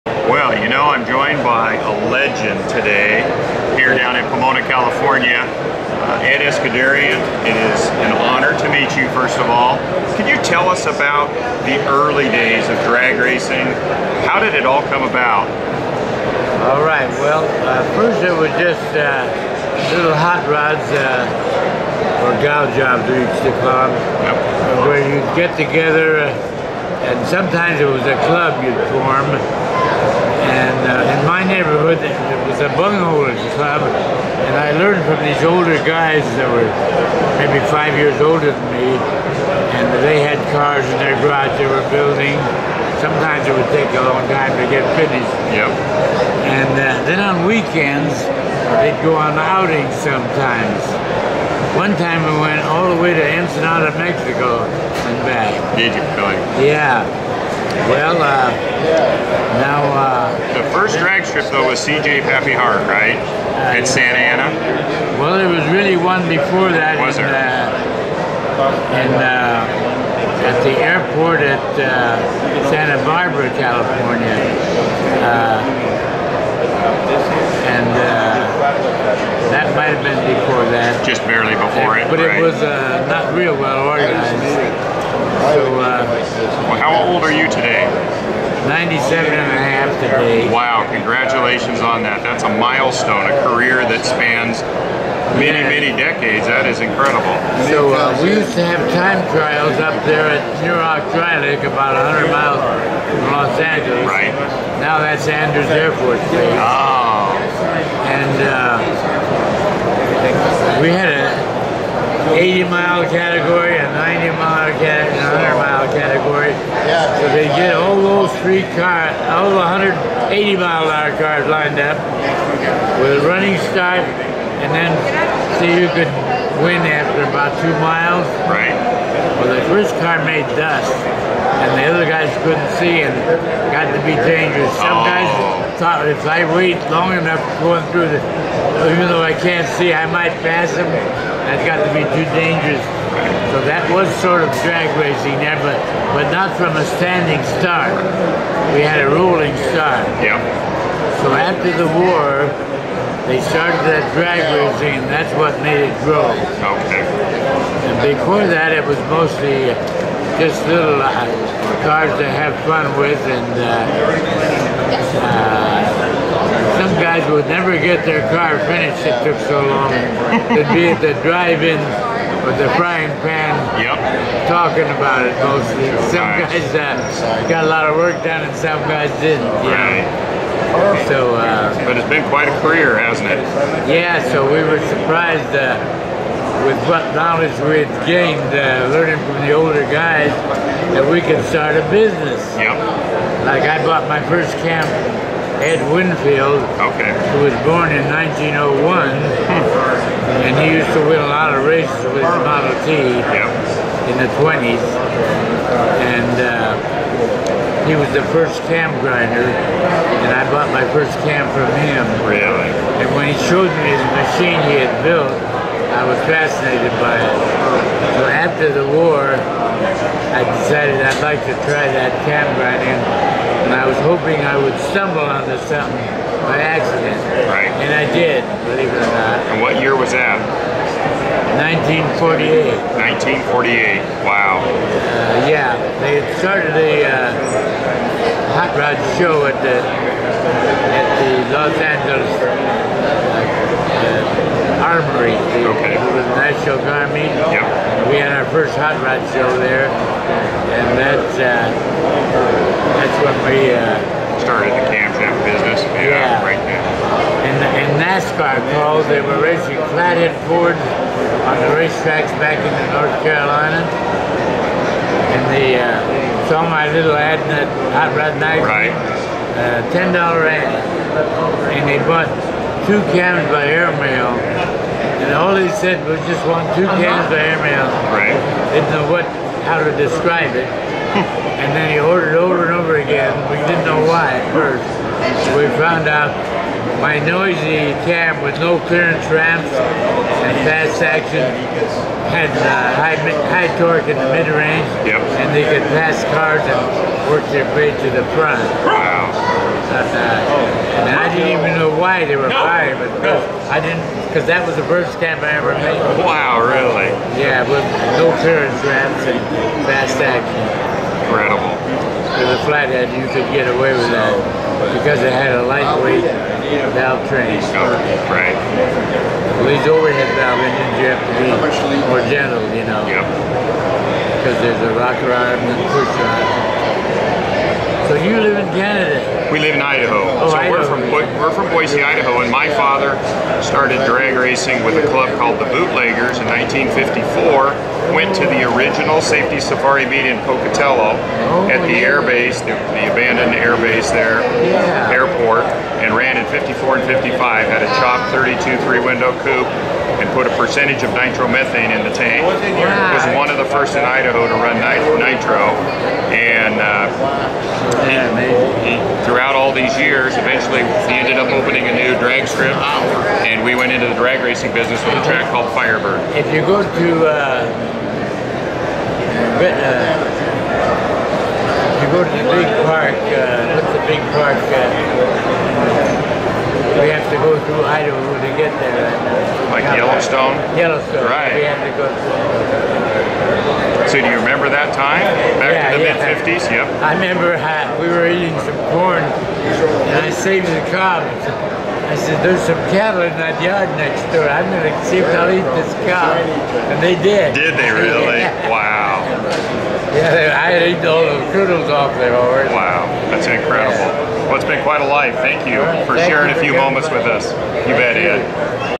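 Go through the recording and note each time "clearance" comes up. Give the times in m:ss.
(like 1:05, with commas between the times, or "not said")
4:48, 5:08.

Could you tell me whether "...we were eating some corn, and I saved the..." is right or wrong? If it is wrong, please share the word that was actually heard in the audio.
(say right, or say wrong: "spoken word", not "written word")
right.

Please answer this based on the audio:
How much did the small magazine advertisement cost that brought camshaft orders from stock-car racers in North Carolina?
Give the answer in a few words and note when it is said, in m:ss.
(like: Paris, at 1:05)
$10, at 4:29.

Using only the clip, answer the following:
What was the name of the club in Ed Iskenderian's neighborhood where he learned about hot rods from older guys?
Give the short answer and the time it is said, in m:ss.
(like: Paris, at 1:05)
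bunghole club, at 0:32.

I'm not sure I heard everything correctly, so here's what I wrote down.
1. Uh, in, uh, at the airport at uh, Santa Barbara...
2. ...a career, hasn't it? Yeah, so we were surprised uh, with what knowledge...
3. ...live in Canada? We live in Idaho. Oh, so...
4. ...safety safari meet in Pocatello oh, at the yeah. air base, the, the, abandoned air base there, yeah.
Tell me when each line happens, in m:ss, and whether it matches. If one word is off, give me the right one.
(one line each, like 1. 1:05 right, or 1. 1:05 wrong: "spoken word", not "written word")
1. 1:08 right
2. 3:02 right
3. 5:28 right
4. 5:39 right.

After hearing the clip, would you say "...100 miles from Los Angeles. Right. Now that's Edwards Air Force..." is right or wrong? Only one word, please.
right.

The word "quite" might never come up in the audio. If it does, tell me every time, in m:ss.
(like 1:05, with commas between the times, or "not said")
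3:02, 6:44.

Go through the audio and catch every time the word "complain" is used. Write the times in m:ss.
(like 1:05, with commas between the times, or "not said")
not said.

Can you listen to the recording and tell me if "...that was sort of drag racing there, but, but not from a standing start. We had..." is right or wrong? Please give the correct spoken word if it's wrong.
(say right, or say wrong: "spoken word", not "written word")
right.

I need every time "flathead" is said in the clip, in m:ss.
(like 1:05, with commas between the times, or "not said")
4:19, 5:12.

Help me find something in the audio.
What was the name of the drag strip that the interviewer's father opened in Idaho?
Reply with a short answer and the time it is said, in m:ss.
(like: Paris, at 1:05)
Firebird, at 6:05.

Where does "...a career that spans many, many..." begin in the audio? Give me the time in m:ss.
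1:33.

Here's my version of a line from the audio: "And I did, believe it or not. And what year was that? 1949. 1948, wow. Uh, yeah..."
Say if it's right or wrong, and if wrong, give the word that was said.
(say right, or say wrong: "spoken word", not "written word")
wrong: "1948", not "1949".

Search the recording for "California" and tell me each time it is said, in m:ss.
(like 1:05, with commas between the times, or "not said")
0:04, 1:13.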